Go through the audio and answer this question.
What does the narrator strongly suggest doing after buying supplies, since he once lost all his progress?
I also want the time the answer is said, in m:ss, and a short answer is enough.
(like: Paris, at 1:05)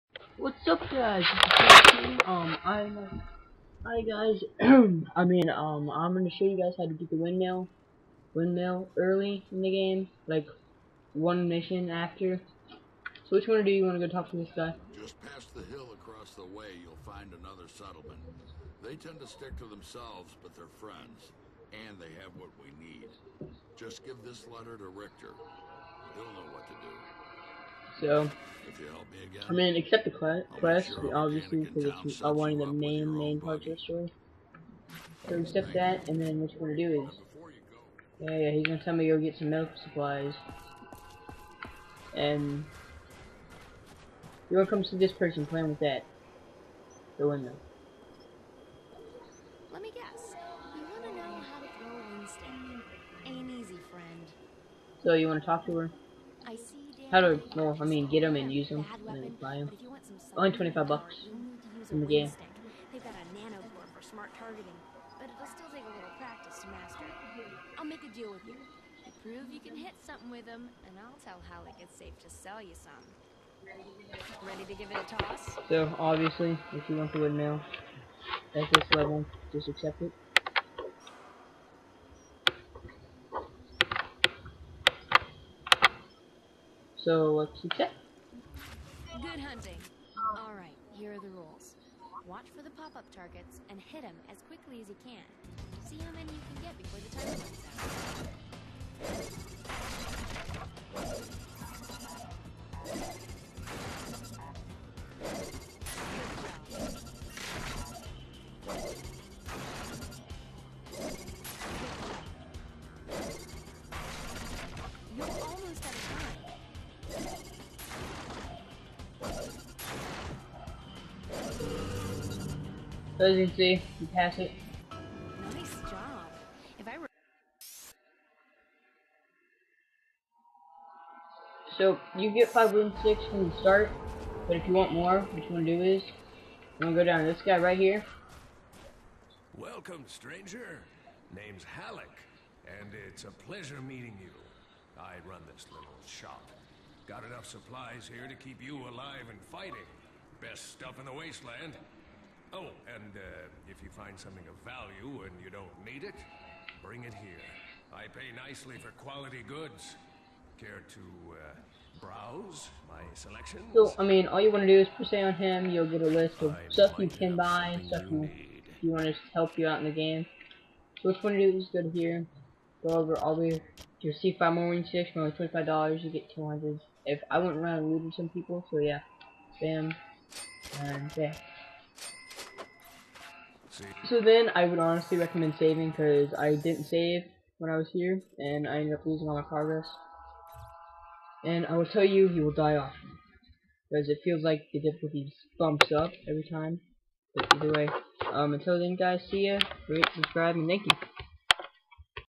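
Saving, at 3:05.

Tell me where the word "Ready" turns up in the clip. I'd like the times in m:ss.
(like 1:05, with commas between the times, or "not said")
1:14.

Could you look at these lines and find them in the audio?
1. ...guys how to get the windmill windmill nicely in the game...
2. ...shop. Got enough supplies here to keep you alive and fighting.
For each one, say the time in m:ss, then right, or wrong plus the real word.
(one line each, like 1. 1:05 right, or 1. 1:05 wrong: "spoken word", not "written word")
1. 0:06 wrong: "early", not "nicely"
2. 2:26 right.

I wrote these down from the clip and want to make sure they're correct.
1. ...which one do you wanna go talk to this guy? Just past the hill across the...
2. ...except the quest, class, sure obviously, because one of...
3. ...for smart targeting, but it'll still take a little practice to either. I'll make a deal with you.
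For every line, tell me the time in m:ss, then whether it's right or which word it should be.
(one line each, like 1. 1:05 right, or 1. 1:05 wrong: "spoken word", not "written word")
1. 0:13 right
2. 0:29 right
3. 1:03 wrong: "master", not "either".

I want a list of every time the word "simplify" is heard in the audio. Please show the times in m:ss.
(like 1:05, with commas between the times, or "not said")
not said.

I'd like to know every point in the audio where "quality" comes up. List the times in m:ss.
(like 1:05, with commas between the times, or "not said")
2:39.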